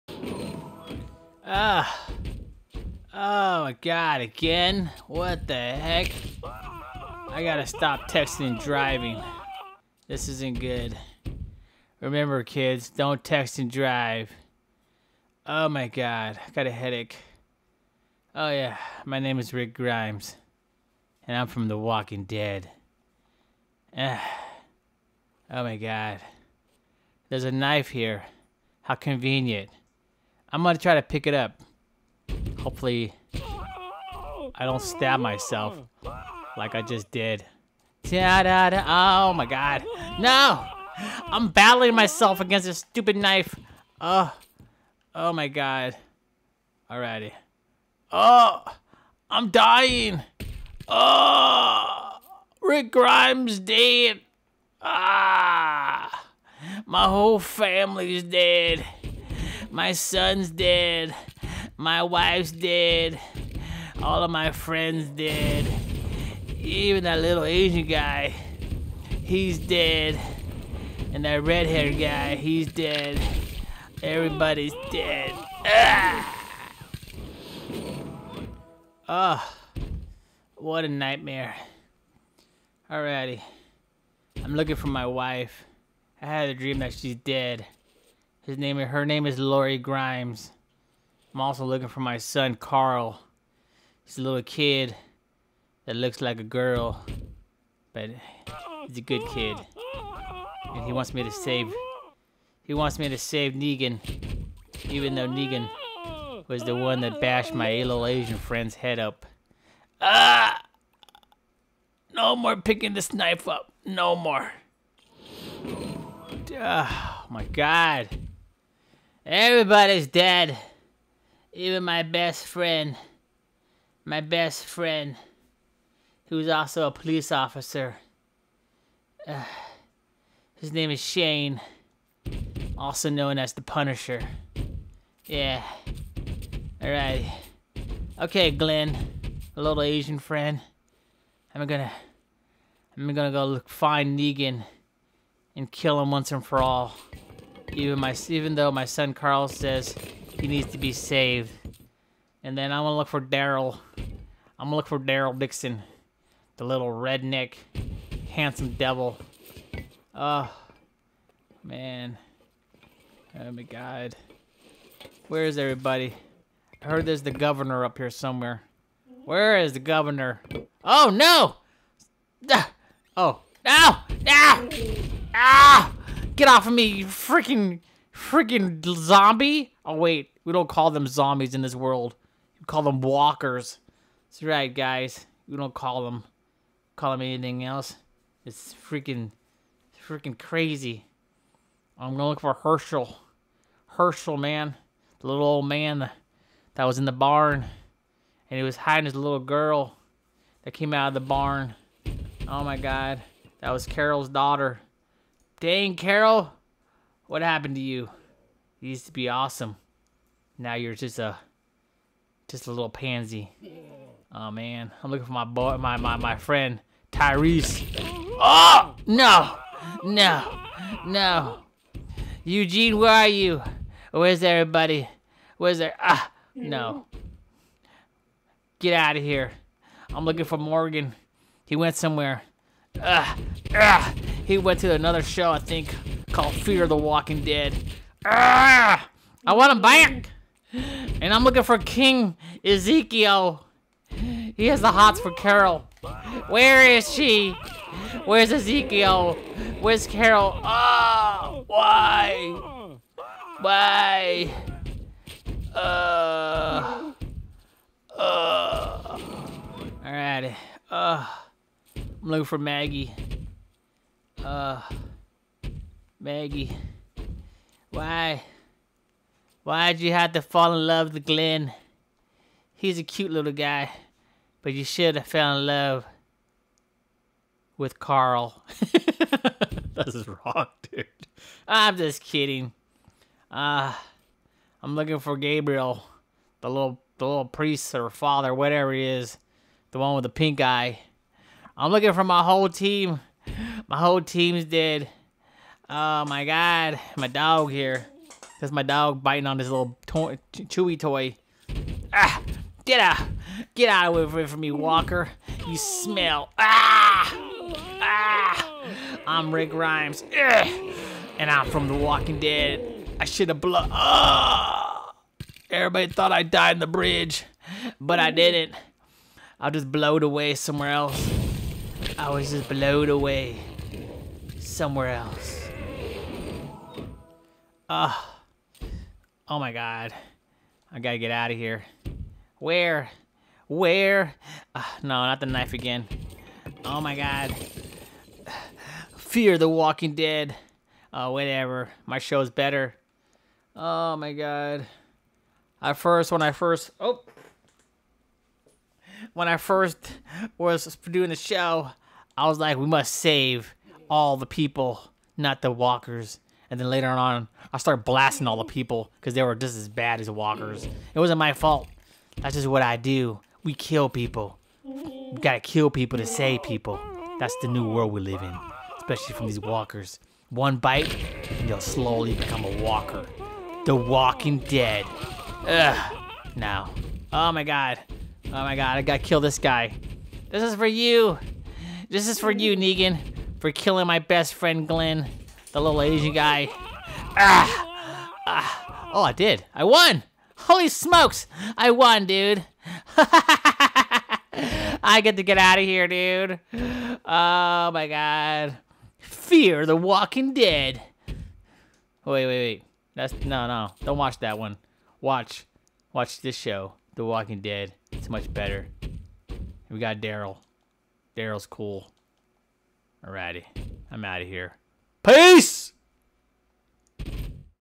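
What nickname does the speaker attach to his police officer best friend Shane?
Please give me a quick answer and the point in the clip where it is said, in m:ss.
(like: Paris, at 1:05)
The Punisher, at 2:13.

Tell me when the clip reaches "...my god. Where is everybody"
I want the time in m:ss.
2:43.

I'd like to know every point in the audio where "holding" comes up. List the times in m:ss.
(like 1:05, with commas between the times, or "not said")
not said.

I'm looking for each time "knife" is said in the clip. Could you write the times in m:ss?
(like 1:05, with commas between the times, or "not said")
0:27, 0:43, 1:53, 5:35.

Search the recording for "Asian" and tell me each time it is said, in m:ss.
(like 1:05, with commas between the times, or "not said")
1:07, 1:48, 2:19, 6:26.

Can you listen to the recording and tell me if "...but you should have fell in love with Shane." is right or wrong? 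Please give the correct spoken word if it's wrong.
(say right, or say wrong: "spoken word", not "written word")
wrong: "Carl", not "Shane".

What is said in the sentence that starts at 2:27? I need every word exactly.
Even my even though my son Carl says he needs to be saved.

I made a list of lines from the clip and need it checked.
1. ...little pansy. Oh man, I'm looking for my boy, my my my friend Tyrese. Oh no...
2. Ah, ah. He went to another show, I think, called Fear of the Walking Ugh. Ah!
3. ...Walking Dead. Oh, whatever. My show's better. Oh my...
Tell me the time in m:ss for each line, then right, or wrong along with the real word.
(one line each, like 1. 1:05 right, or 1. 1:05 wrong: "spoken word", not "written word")
1. 3:32 right
2. 3:52 wrong: "Dead", not "Ugh"
3. 5:39 right.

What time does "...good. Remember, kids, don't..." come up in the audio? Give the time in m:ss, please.
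0:10.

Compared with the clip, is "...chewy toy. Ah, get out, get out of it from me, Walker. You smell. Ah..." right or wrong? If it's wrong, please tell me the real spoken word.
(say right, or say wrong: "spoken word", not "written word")
right.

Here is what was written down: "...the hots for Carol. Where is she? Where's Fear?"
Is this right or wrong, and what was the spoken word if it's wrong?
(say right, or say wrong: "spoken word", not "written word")
wrong: "Ezekiel", not "Fear".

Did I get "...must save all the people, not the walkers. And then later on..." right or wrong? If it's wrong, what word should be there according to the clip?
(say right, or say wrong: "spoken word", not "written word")
right.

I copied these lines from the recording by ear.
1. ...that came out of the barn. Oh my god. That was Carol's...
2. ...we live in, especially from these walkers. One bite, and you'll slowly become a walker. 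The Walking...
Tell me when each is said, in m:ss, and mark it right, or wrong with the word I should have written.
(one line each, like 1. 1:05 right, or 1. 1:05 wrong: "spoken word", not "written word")
1. 3:20 right
2. 6:08 right.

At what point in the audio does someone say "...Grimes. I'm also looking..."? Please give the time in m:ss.
1:29.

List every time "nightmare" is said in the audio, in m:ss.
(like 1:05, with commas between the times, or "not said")
1:20.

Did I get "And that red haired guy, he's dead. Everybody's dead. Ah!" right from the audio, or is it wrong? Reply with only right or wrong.
right.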